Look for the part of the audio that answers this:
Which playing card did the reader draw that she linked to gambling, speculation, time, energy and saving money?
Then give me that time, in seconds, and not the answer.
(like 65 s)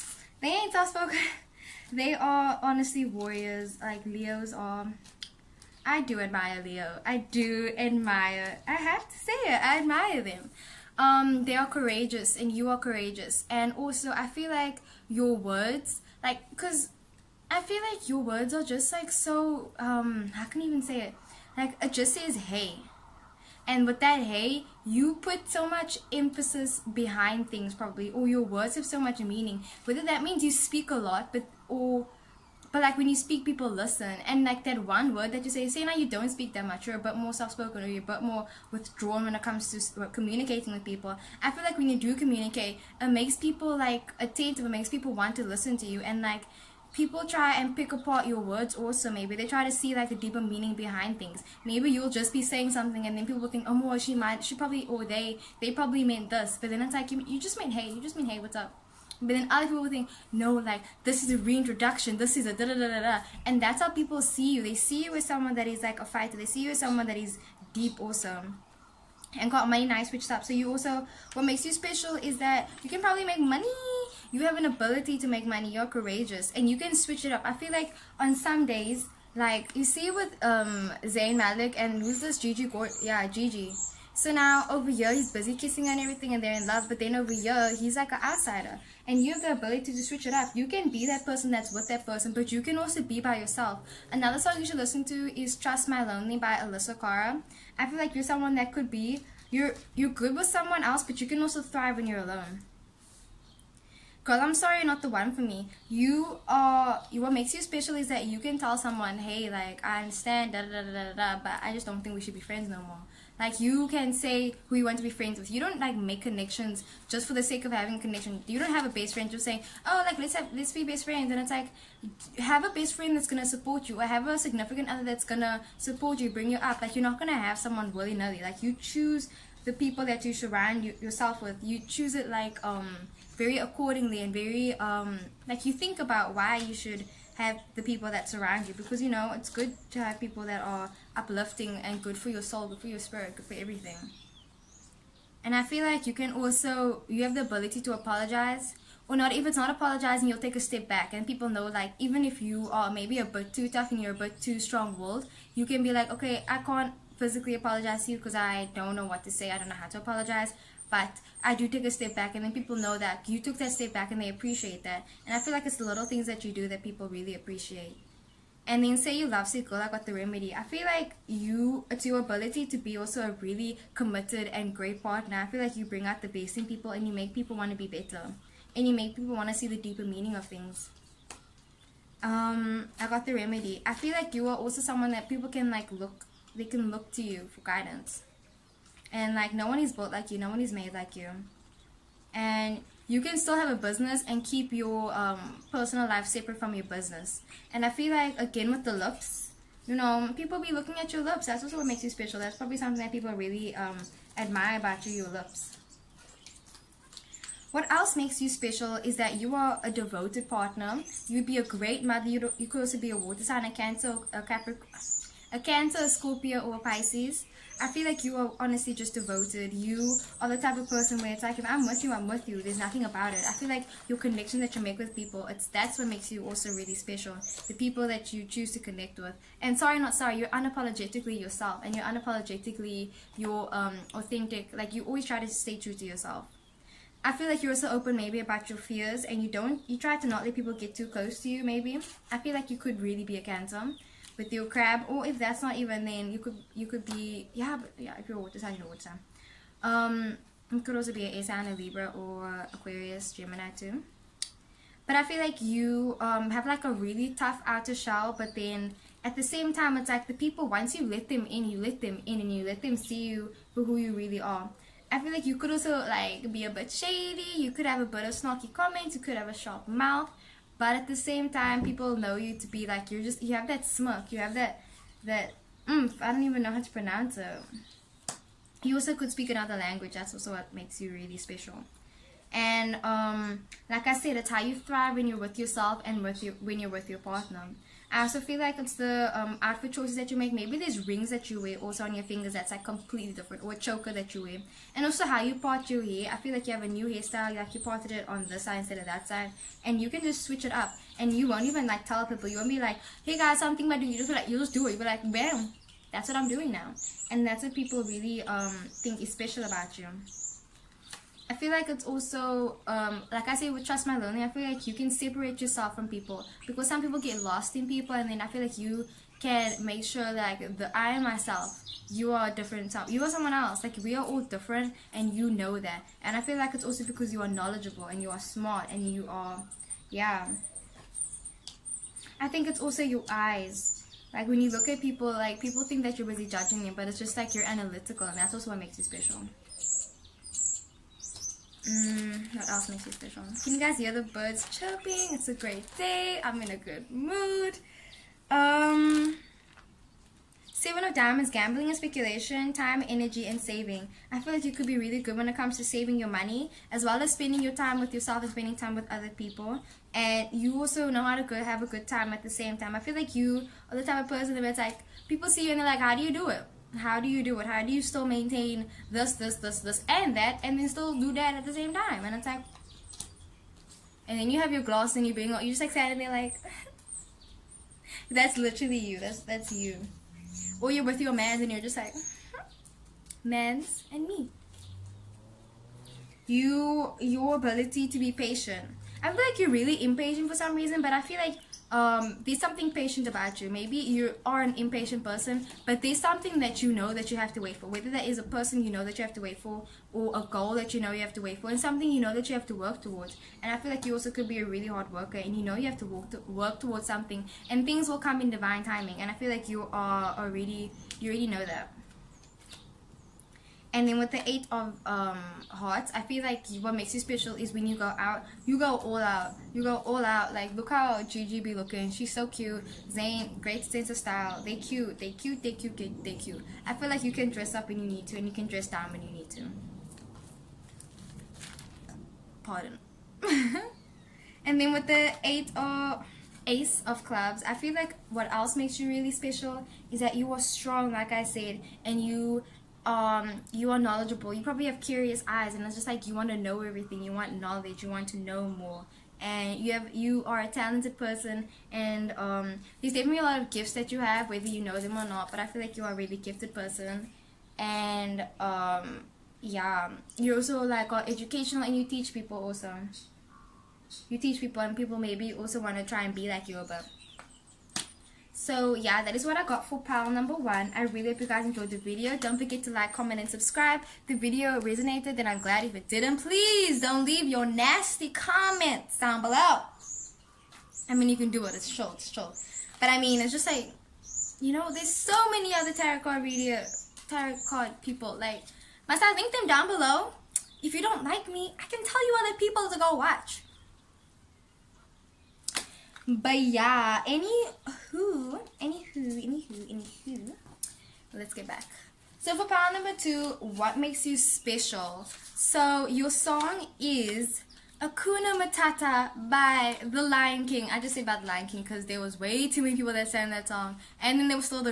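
350 s.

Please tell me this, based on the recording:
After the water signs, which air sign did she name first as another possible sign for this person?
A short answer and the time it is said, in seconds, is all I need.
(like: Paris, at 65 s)
Libra, at 251 s.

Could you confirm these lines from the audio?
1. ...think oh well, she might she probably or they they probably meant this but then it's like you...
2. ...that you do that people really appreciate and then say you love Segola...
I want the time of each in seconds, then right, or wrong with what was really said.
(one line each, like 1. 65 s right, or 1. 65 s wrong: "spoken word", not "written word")
1. 53 s right
2. 166 s right.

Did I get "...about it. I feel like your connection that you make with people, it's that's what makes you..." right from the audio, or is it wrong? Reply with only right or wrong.
right.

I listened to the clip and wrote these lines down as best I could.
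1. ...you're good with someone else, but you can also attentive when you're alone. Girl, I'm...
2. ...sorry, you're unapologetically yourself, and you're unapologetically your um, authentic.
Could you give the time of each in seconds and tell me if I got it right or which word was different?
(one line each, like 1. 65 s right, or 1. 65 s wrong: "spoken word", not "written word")
1. 99 s wrong: "thrive", not "attentive"
2. 230 s right.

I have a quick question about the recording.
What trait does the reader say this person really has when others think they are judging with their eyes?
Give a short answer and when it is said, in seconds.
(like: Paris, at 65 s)
Analytical, at 337 s.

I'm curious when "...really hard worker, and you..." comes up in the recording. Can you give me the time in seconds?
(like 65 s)
404 s.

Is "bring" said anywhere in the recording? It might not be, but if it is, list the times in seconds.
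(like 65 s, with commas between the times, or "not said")
126 s, 175 s.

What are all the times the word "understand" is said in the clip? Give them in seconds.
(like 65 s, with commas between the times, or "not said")
110 s.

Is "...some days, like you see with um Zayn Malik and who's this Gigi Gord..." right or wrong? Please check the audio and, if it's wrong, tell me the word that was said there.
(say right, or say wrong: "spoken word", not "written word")
right.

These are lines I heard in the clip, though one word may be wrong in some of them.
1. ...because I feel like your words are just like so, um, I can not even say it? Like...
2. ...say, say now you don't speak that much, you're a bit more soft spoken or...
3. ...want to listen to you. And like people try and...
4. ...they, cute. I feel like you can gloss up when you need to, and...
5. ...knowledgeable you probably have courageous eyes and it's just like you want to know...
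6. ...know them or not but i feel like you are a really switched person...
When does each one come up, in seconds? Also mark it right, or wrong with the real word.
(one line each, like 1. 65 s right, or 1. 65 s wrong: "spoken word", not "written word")
1. 16 s right
2. 35 s right
3. 45 s right
4. 426 s wrong: "dress", not "gloss"
5. 443 s wrong: "curious", not "courageous"
6. 454 s wrong: "gifted", not "switched".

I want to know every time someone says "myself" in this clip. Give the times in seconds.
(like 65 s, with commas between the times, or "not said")
321 s.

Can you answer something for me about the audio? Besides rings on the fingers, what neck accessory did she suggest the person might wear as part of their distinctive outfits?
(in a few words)
Choker.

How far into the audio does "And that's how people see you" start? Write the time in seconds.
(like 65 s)
63 s.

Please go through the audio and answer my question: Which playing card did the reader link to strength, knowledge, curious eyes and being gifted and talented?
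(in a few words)
Ace of clubs.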